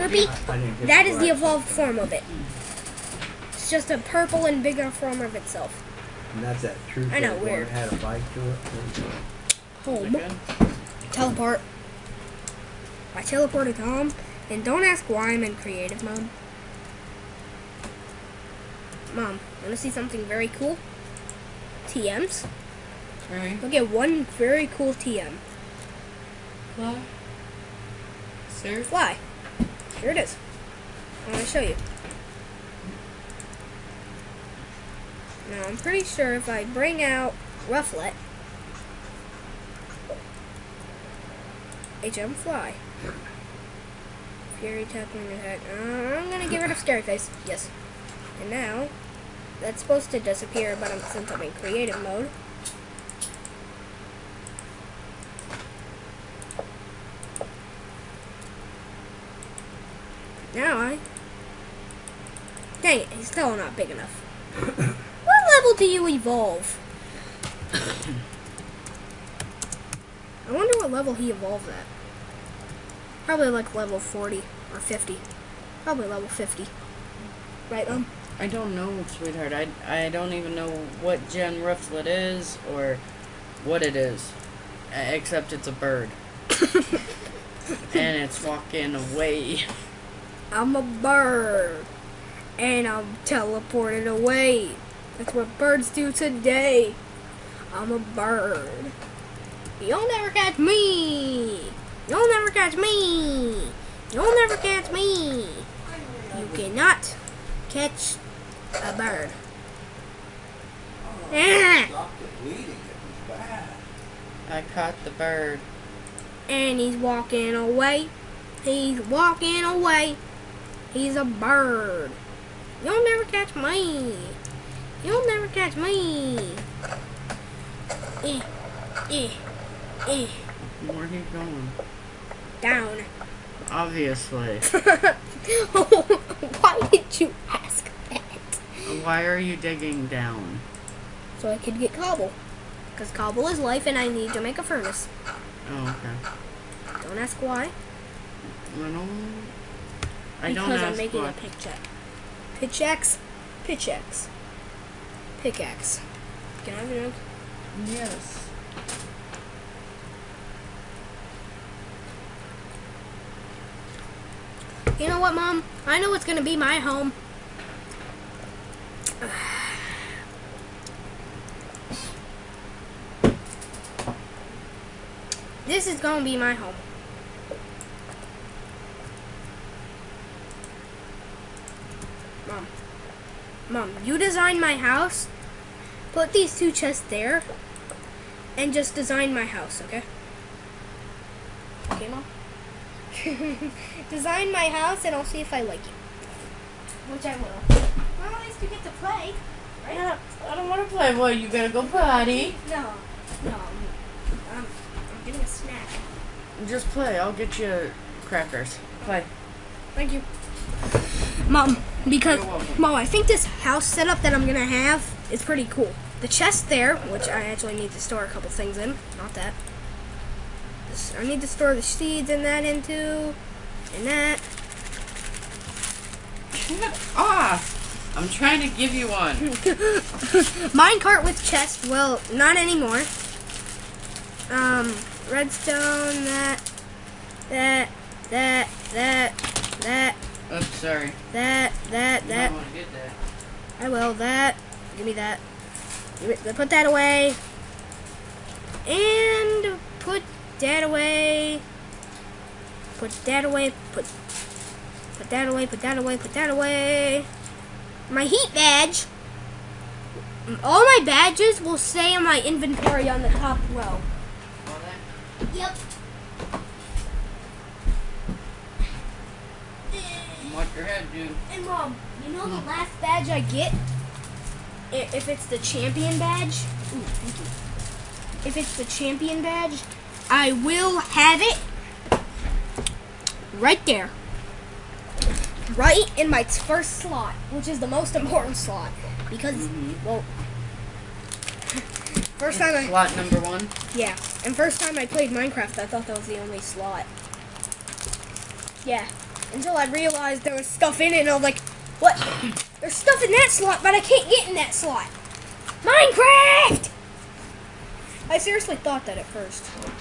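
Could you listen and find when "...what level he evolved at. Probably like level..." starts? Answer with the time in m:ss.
1:10.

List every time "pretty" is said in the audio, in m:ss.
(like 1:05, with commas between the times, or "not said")
0:35, 3:35.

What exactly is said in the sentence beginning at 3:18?
Well, at least you get to play, right?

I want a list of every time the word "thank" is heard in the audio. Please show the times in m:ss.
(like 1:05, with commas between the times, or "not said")
3:29, 4:37.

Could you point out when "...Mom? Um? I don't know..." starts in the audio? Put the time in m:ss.
1:17.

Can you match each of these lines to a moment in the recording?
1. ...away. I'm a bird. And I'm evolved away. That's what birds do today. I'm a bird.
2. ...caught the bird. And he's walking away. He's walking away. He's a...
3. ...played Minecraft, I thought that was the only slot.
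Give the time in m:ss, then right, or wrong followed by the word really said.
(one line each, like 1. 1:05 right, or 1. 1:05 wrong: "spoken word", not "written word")
1. 1:28 wrong: "teleported", not "evolved"
2. 1:54 right
3. 4:55 right.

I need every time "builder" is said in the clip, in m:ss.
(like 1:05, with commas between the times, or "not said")
not said.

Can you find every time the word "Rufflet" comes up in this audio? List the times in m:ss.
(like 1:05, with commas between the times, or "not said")
0:37, 1:21.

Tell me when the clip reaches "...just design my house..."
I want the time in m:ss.
3:08.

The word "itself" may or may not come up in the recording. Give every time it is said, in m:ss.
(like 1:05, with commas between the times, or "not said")
0:05.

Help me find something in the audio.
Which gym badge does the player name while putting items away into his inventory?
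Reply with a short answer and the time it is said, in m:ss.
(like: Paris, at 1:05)
heat badge, at 4:18.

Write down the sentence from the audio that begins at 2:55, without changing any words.
This is going to be my home.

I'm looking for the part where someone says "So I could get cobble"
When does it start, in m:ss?
2:21.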